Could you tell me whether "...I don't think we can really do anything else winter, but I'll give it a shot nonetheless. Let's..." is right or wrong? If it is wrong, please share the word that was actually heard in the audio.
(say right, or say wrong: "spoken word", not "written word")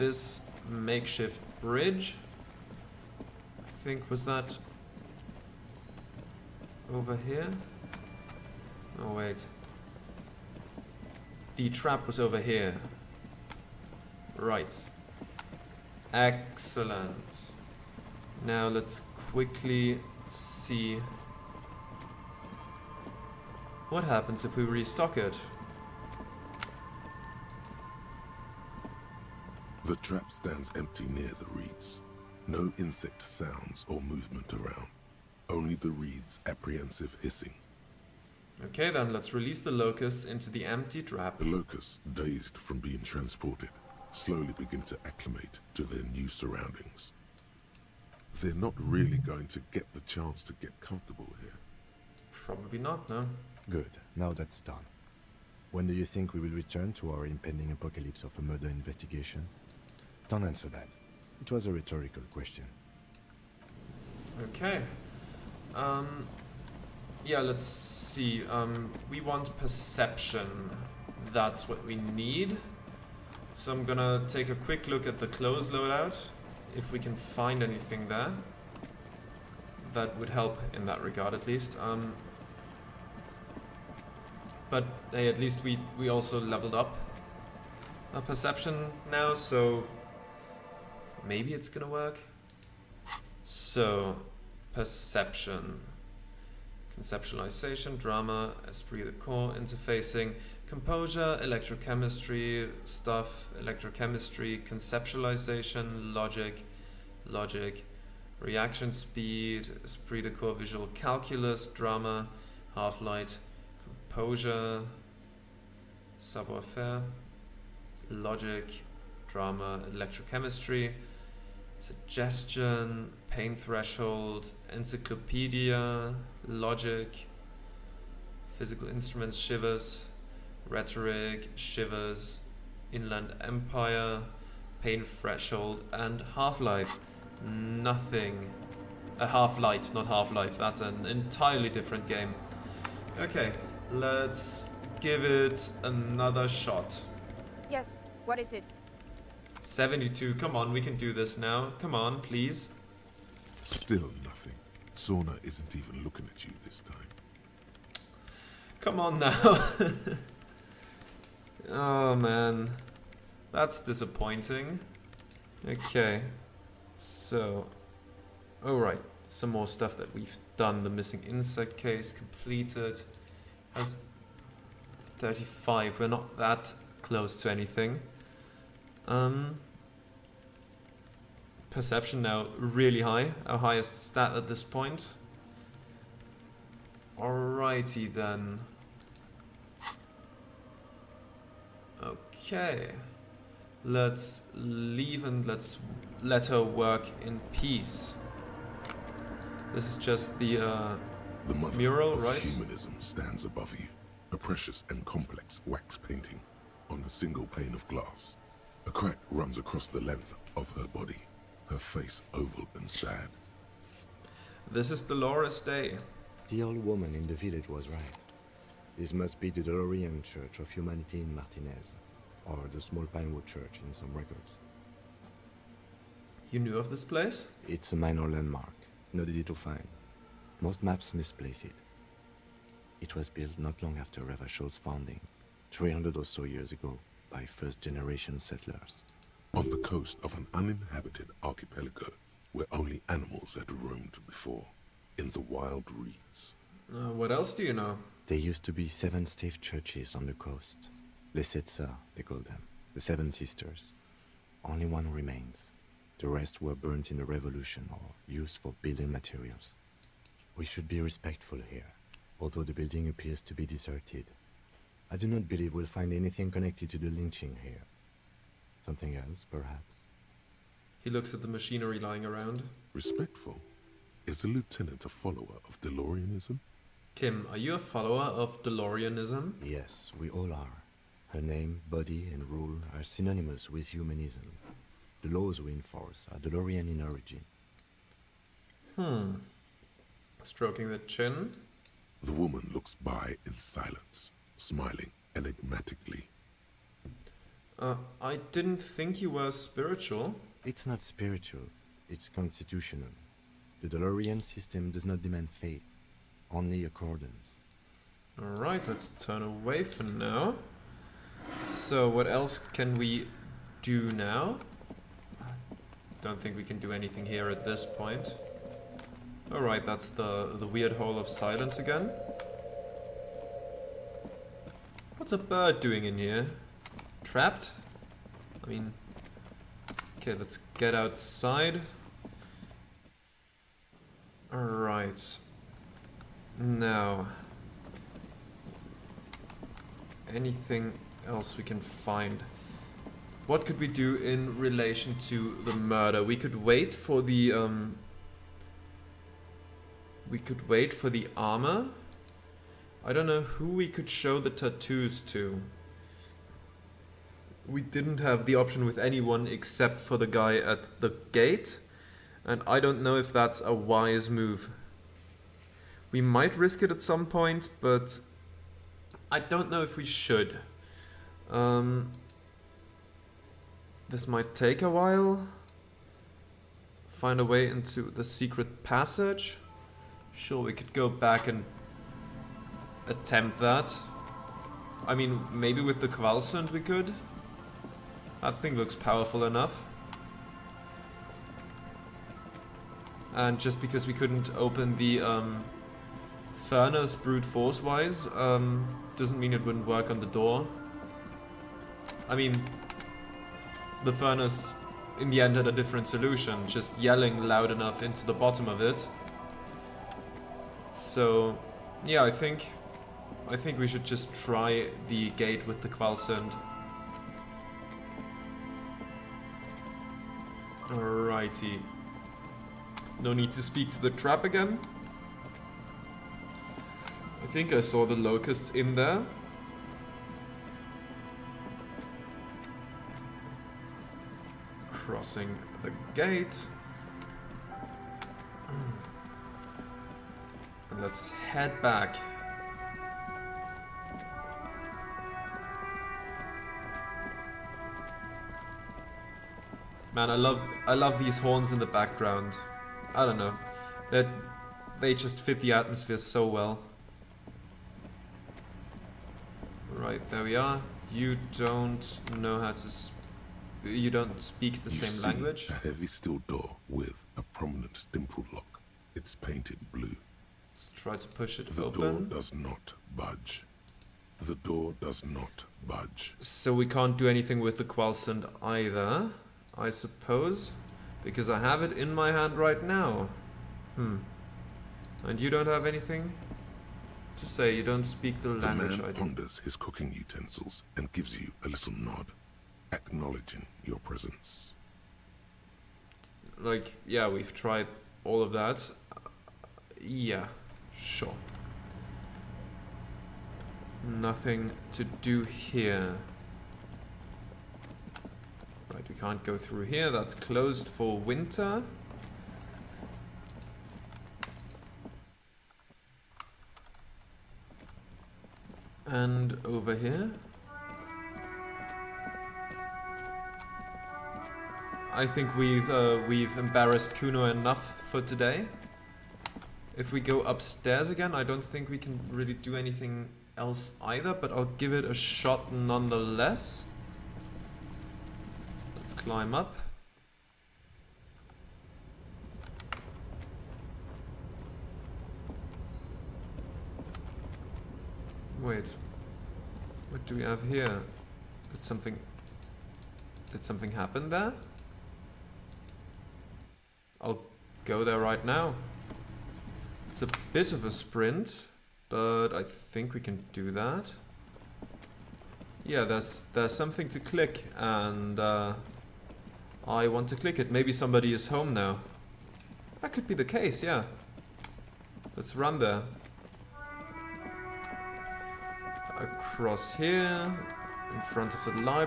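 wrong: "either", not "winter".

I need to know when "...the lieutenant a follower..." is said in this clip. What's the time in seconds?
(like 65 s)
274 s.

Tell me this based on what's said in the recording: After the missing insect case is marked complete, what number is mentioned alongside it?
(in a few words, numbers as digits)
35.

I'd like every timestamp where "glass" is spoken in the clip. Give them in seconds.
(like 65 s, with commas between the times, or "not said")
207 s.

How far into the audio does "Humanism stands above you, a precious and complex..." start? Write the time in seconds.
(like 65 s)
202 s.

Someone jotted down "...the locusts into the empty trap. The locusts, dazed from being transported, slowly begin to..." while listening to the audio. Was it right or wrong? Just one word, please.
right.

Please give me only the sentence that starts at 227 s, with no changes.
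It's a minor landmark, not easy to find.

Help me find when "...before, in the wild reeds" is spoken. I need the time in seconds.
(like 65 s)
244 s.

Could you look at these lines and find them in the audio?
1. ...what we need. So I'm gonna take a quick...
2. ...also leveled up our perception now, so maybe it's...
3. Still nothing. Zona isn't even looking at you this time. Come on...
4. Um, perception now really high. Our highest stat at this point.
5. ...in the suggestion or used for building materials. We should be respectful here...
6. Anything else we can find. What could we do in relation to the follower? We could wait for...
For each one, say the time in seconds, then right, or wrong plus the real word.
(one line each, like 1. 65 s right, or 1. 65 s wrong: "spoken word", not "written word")
1. 71 s right
2. 86 s right
3. 153 s right
4. 179 s right
5. 257 s wrong: "revolution", not "suggestion"
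6. 340 s wrong: "murder", not "follower".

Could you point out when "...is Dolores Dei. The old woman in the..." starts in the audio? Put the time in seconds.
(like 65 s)
214 s.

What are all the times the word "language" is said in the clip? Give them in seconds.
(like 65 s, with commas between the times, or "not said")
465 s, 488 s.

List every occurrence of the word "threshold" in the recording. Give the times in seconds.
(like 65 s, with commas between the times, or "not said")
123 s, 135 s.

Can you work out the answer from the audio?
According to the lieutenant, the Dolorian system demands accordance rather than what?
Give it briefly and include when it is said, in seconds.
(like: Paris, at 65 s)
Faith, at 305 s.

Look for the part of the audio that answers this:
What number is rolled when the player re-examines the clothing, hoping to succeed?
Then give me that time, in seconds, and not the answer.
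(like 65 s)
149 s.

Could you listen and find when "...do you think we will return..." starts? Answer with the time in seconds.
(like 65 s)
55 s.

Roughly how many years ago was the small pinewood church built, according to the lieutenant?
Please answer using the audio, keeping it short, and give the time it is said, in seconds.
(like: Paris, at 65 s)
300, at 235 s.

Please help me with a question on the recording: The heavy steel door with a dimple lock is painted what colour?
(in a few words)
Blue.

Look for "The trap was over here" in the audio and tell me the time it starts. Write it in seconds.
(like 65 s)
11 s.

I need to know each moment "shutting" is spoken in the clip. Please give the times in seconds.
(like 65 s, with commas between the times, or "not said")
not said.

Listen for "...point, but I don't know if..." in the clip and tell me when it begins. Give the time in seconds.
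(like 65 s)
367 s.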